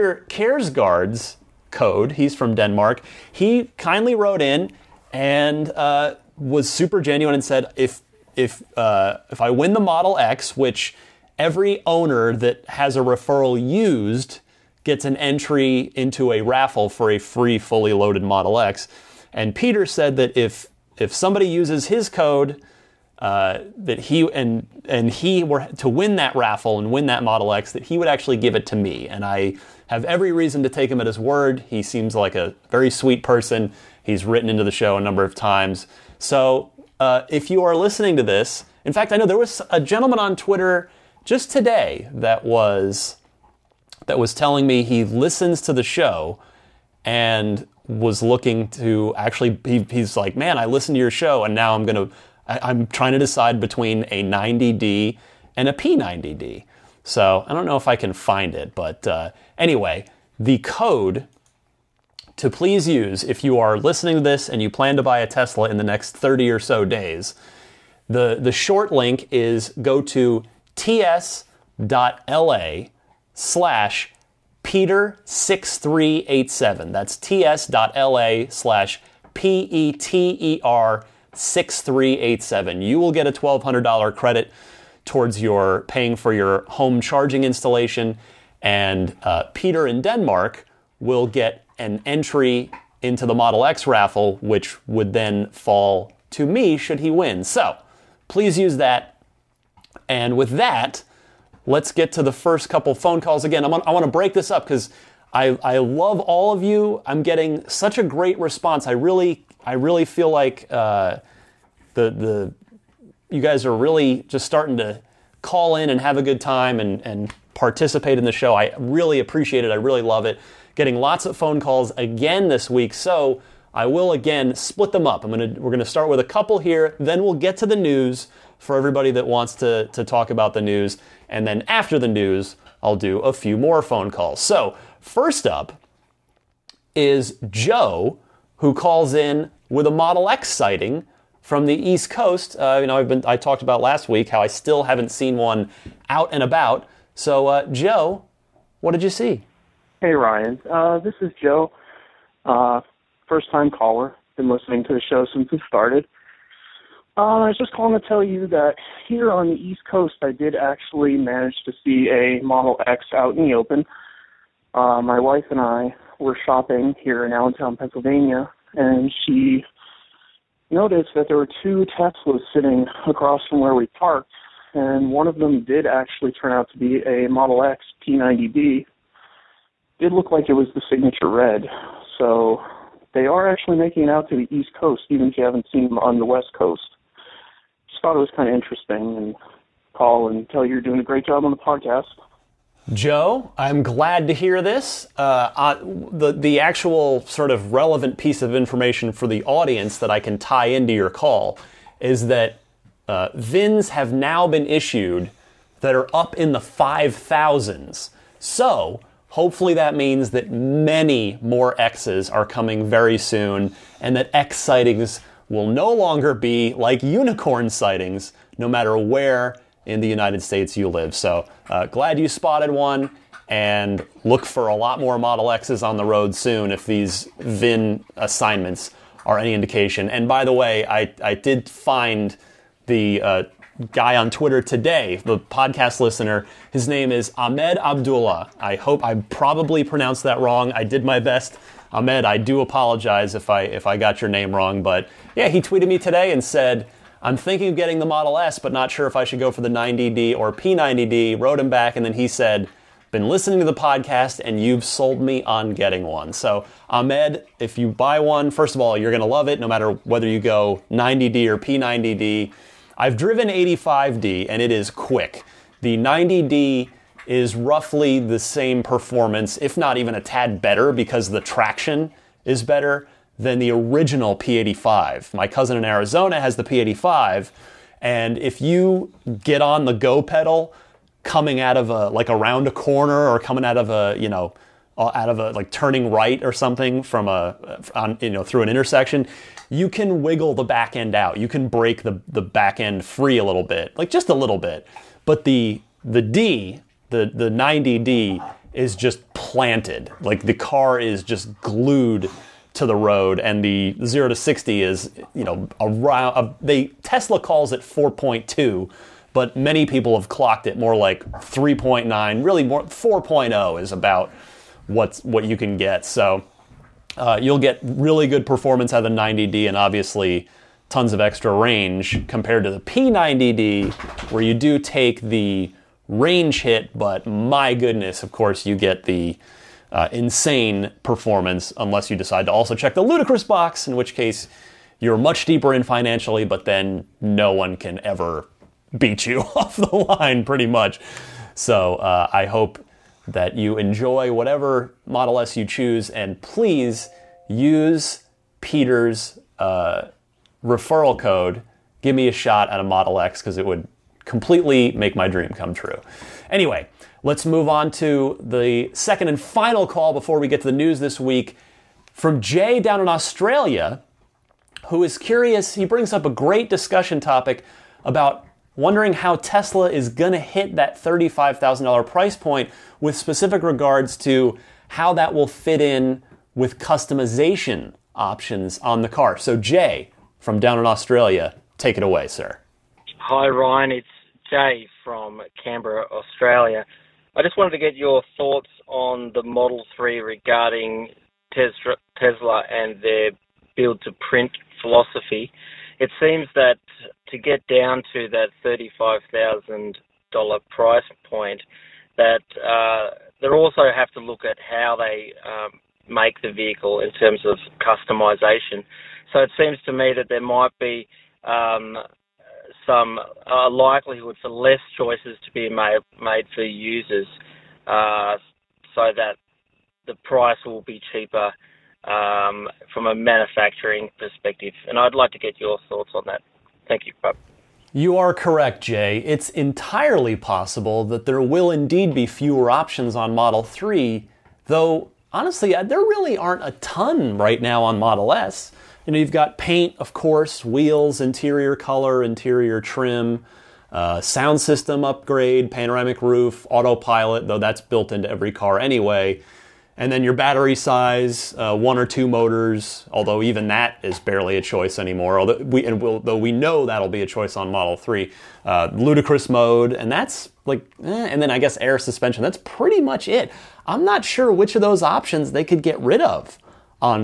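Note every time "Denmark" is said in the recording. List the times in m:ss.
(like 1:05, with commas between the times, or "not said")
0:02, 1:30.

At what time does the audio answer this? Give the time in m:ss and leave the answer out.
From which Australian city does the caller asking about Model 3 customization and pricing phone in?
6:25.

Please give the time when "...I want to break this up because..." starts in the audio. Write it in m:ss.
1:43.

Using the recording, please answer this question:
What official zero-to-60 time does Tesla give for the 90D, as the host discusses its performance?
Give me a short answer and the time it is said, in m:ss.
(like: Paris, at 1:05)
4.2, at 5:07.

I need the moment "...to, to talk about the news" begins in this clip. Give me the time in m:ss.
2:09.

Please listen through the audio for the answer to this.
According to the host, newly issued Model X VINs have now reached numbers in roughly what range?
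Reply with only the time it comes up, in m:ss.
3:26.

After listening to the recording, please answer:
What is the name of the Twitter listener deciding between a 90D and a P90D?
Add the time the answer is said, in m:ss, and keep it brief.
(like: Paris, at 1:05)
Ahmed Abdullah, at 3:57.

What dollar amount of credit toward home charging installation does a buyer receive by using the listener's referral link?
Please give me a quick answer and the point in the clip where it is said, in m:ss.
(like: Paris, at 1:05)
$1,200, at 1:23.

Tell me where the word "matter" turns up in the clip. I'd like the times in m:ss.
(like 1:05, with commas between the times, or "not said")
3:38, 4:19.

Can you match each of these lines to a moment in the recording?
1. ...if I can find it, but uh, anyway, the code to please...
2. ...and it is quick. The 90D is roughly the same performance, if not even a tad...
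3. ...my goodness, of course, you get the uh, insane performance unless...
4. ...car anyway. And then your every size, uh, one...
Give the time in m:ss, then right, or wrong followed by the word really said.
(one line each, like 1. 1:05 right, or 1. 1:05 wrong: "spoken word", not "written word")
1. 0:57 right
2. 4:24 right
3. 5:27 right
4. 7:28 wrong: "battery", not "every".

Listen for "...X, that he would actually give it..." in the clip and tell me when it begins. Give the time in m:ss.
0:27.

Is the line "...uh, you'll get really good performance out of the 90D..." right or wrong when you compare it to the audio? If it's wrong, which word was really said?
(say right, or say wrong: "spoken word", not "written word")
right.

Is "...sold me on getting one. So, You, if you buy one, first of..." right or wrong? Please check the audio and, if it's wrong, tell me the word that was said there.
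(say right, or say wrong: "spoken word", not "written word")
wrong: "Ahmed", not "You".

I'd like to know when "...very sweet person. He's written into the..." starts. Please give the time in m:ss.
0:32.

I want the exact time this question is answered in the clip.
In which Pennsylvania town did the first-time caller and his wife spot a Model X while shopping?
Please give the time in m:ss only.
2:47.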